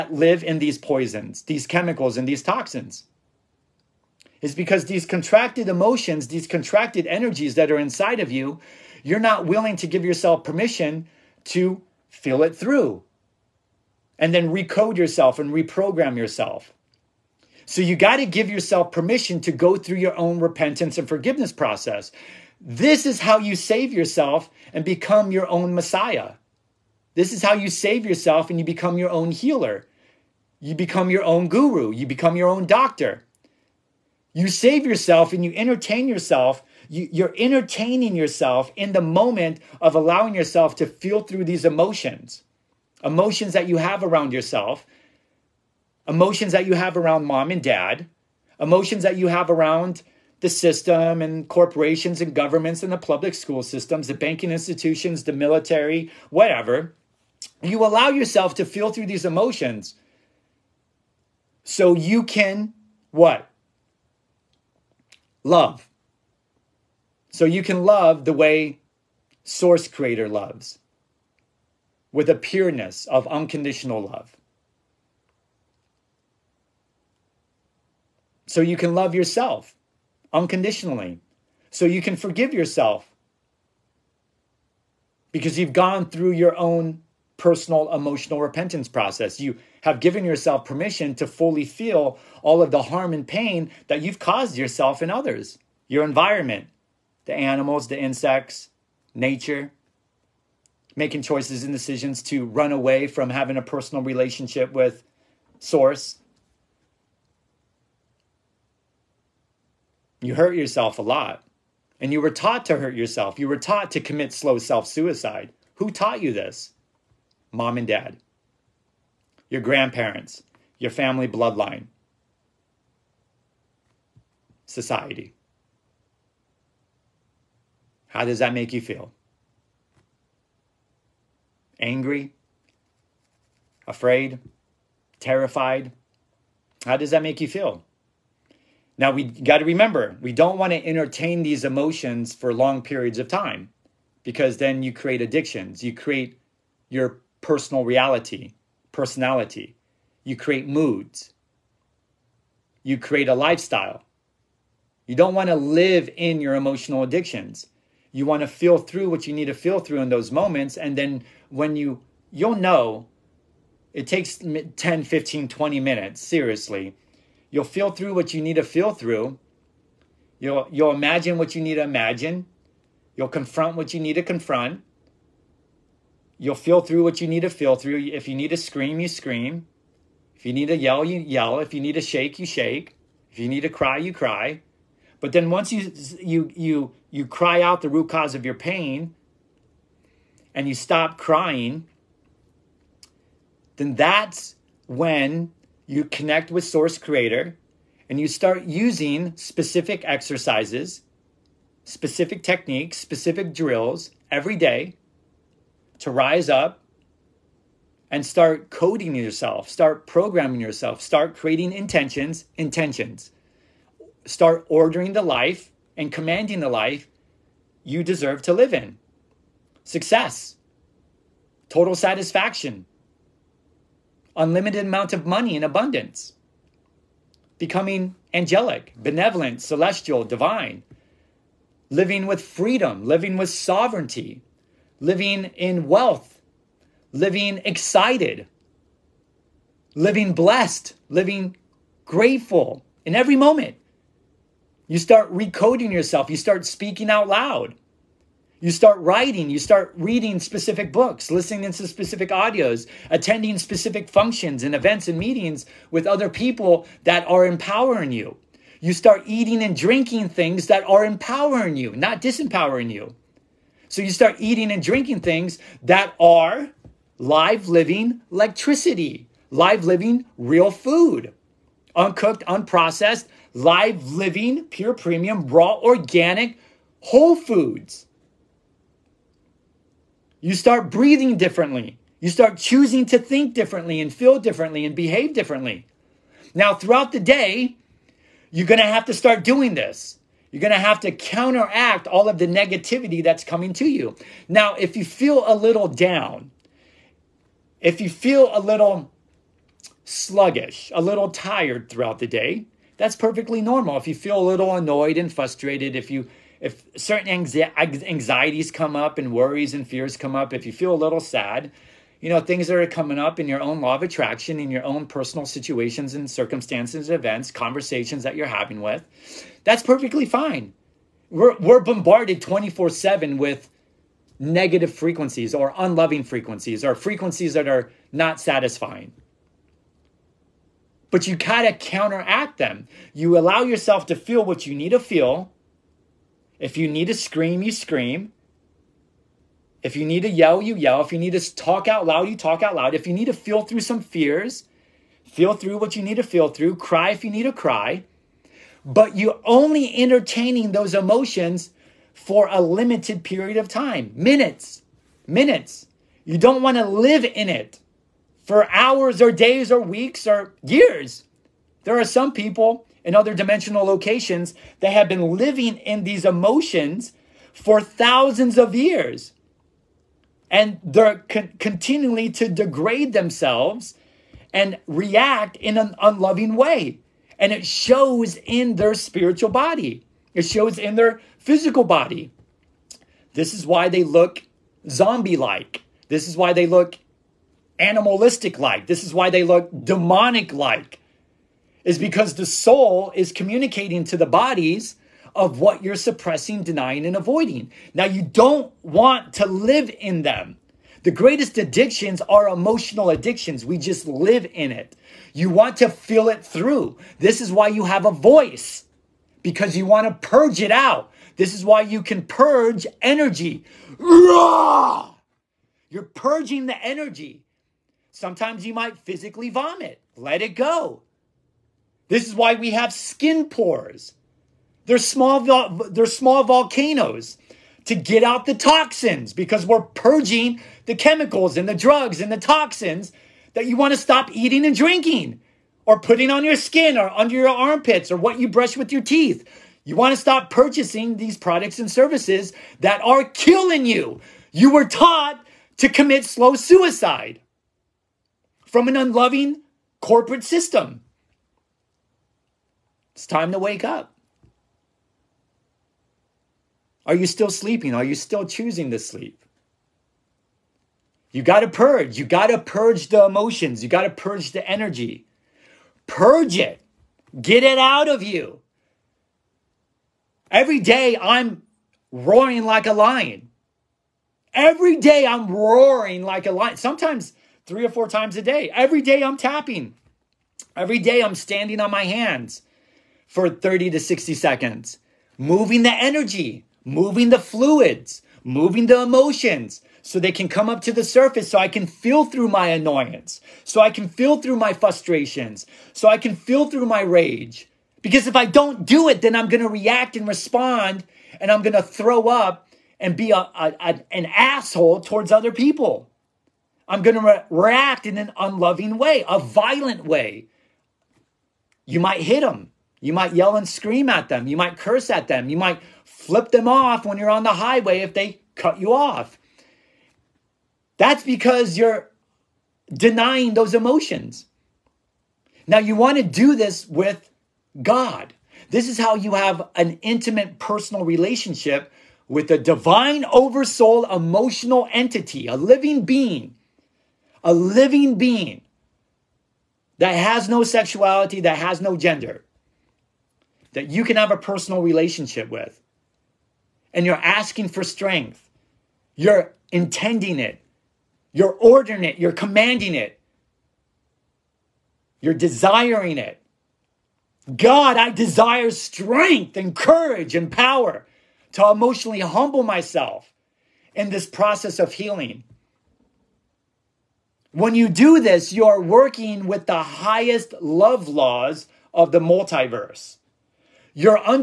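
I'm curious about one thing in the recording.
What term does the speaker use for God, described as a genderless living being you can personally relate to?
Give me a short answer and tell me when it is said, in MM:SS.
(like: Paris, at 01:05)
divine oversoul emotional entity, at 08:52.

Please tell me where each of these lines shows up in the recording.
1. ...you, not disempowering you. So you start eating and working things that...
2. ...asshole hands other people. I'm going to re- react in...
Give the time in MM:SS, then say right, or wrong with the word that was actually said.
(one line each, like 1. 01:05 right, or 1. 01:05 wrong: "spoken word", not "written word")
1. 04:21 wrong: "drinking", not "working"
2. 08:24 wrong: "towards", not "hands".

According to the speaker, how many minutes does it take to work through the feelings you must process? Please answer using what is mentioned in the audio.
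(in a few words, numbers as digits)
10, 15, 20 minutes.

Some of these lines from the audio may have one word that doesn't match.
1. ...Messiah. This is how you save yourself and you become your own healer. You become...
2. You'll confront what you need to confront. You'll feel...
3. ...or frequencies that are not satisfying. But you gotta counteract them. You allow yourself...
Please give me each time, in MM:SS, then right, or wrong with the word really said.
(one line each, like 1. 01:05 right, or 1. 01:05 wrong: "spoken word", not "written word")
1. 00:25 right
2. 02:53 right
3. 05:26 right.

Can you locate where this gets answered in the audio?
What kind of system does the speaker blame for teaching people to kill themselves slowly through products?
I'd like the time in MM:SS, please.
07:28.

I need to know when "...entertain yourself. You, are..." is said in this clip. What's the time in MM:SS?
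00:35.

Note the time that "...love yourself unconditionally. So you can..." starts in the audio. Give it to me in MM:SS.
01:18.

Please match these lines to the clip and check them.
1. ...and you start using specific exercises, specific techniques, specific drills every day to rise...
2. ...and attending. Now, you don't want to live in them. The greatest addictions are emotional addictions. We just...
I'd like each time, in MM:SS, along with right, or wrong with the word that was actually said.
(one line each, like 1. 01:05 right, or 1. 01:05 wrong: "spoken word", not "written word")
1. 03:18 right
2. 06:37 wrong: "avoiding", not "attending".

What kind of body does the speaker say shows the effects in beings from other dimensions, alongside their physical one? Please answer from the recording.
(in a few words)
spiritual body.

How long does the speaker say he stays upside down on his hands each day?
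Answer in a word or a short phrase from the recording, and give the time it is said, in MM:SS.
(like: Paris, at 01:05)
30 to 60 seconds, at 08:03.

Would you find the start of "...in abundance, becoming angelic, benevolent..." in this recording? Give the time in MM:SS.
03:45.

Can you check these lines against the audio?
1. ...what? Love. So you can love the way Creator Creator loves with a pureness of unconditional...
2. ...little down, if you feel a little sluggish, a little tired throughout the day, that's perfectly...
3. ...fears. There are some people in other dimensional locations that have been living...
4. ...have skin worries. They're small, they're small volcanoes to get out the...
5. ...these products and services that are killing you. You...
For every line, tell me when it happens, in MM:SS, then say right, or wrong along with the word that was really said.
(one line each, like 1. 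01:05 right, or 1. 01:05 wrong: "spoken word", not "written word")
1. 01:03 wrong: "Source", not "Creator"
2. 04:55 right
3. 06:00 wrong: "years", not "fears"
4. 07:02 wrong: "pores", not "worries"
5. 07:21 right.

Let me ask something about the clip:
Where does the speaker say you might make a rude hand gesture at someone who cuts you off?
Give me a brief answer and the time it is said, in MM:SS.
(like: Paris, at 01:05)
highway, at 08:37.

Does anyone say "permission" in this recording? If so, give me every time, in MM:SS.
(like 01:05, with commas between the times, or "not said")
00:10, 00:18, 01:30.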